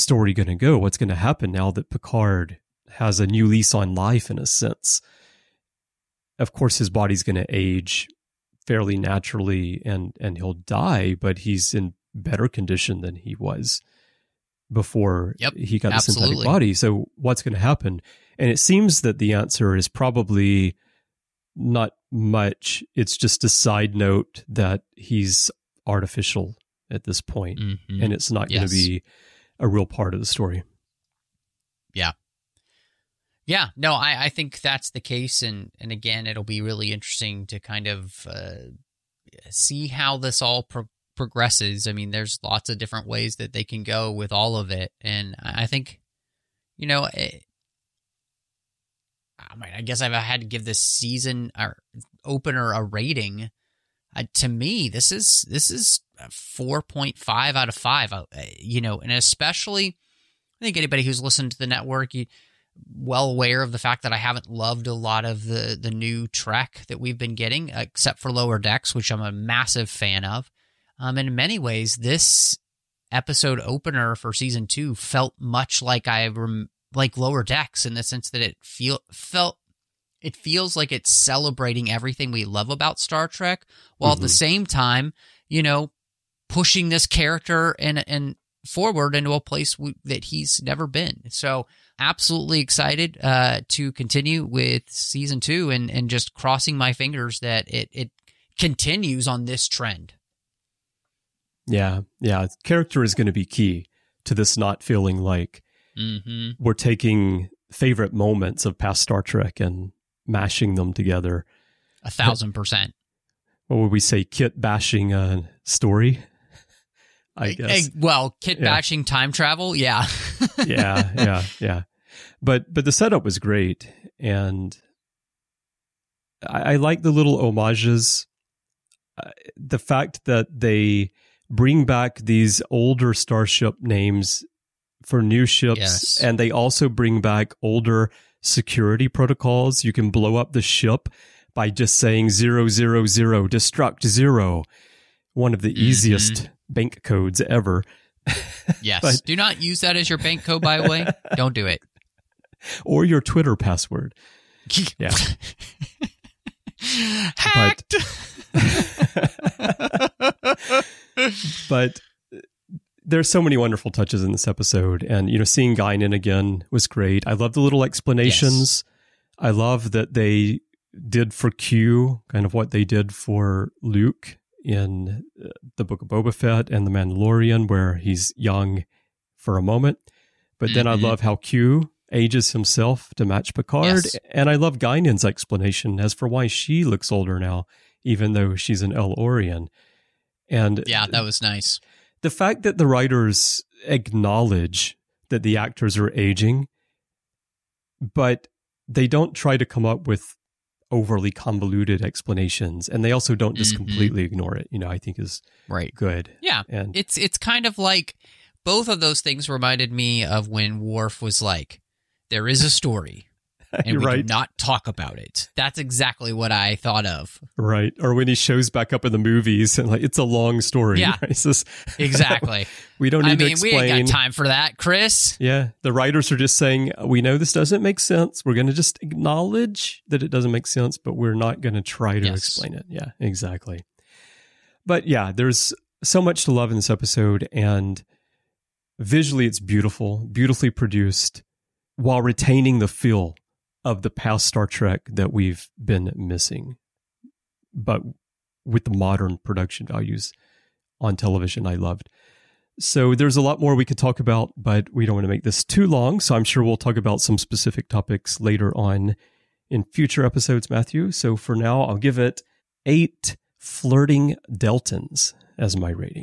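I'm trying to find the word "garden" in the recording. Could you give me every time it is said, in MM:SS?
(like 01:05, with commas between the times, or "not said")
not said.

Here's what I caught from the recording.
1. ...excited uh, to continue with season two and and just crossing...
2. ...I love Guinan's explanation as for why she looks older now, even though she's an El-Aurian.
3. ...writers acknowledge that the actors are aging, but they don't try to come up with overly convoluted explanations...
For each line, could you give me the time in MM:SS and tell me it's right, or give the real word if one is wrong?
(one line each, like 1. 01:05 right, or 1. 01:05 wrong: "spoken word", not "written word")
1. 01:32 right
2. 03:04 right
3. 03:12 right.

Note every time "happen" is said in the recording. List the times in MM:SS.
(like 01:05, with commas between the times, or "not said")
00:01, 00:17.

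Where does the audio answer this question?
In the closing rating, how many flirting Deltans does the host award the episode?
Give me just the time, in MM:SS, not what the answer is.
04:22.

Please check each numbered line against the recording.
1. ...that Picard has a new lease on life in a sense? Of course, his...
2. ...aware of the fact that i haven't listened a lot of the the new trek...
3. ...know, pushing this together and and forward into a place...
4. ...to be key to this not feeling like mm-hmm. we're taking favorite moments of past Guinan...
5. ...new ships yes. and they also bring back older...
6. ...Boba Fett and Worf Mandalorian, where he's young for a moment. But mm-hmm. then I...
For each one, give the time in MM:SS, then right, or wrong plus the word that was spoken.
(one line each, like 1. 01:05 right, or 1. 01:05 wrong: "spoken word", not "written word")
1. 00:01 right
2. 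01:03 wrong: "loved", not "listened"
3. 01:25 wrong: "character", not "together"
4. 01:43 wrong: "Star", not "Guinan"
5. 02:15 right
6. 02:56 wrong: "The", not "Worf".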